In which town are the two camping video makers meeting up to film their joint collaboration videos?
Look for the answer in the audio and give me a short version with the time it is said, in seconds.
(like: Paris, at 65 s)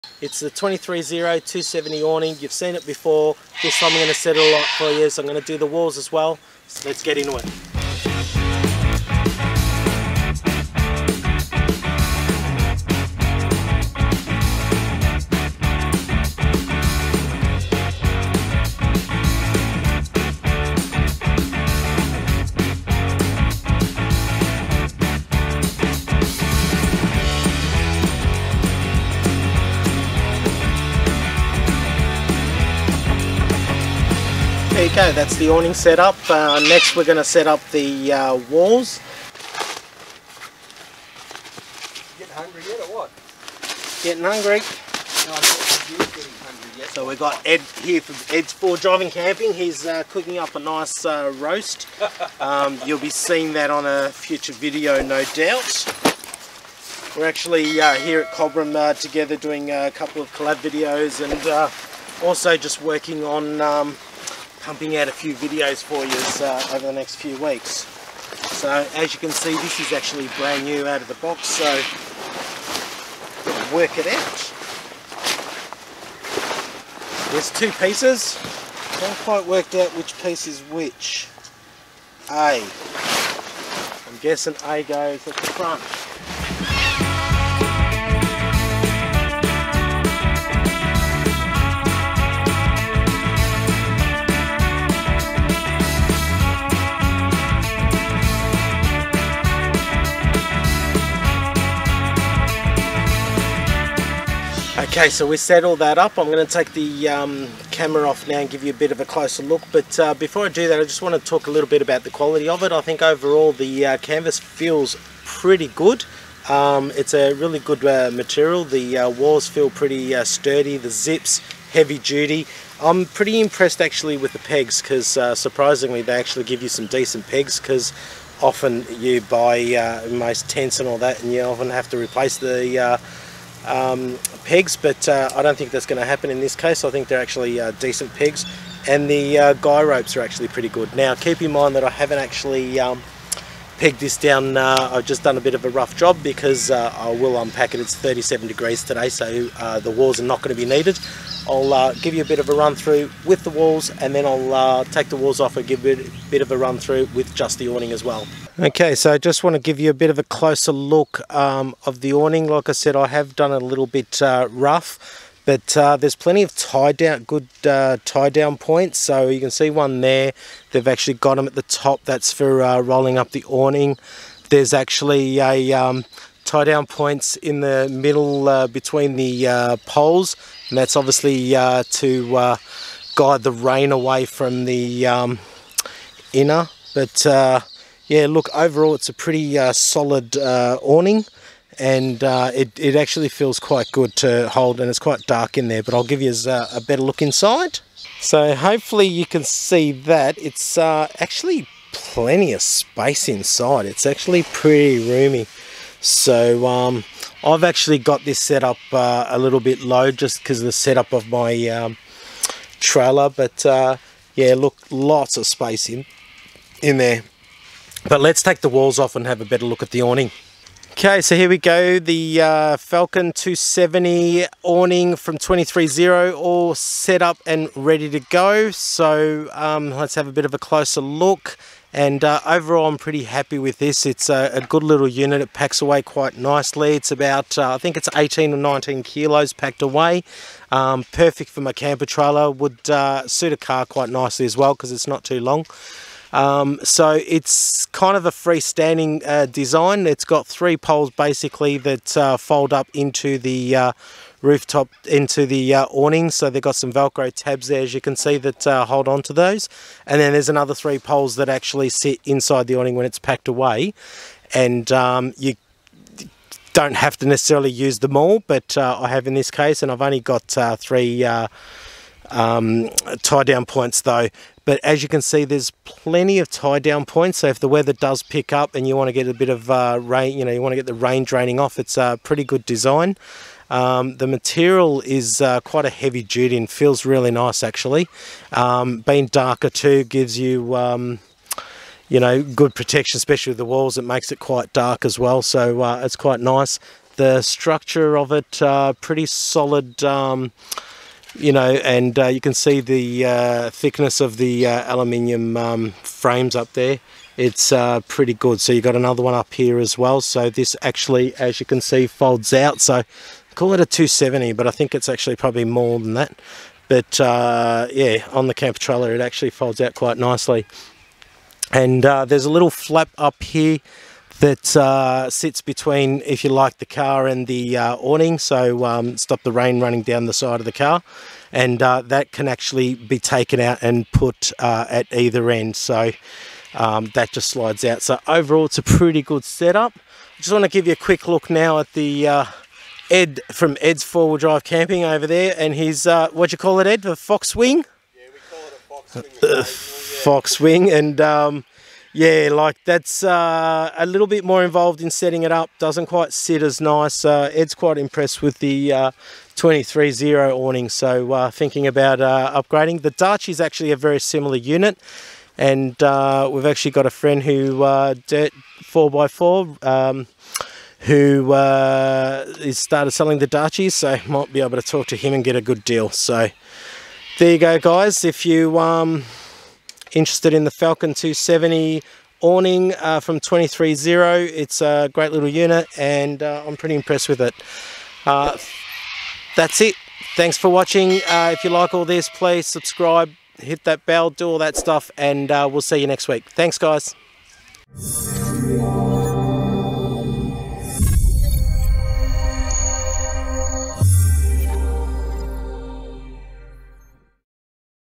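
Cobram, at 58 s.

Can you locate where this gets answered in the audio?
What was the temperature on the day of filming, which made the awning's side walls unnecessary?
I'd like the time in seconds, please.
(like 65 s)
147 s.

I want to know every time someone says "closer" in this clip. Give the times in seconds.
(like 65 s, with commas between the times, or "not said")
109 s, 160 s, 230 s.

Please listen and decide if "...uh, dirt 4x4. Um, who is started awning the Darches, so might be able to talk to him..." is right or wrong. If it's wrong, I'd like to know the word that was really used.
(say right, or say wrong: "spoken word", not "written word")
wrong: "selling", not "awning".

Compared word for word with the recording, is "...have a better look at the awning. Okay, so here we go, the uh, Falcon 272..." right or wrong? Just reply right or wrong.
wrong.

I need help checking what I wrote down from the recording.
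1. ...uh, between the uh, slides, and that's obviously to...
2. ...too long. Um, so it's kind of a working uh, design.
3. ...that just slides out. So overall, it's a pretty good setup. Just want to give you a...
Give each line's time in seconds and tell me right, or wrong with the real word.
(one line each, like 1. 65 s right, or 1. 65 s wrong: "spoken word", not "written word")
1. 178 s wrong: "poles", not "slides"
2. 245 s wrong: "freestanding", not "working"
3. 337 s right.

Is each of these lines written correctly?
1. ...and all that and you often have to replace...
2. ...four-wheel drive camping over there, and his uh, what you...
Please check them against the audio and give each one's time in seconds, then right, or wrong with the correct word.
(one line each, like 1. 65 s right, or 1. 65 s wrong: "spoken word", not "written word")
1. 130 s right
2. 344 s right.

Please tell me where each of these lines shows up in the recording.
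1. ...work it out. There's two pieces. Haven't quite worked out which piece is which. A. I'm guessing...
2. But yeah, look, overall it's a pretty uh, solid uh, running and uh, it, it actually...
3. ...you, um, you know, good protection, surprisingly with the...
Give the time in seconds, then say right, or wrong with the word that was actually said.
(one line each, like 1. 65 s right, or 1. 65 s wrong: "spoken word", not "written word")
1. 73 s right
2. 186 s wrong: "awning", not "running"
3. 290 s wrong: "especially", not "surprisingly".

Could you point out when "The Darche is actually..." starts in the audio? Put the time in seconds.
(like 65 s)
363 s.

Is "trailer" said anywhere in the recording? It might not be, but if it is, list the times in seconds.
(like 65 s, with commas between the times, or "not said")
212 s, 242 s, 318 s.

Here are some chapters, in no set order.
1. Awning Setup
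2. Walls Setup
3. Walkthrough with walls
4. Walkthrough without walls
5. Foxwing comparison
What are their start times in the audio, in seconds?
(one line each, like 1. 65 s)
1. 31 s
2. 109 s
3. 181 s
4. 243 s
5. 365 s.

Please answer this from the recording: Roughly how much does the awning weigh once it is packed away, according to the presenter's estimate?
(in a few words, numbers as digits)
18 or 19 kilos.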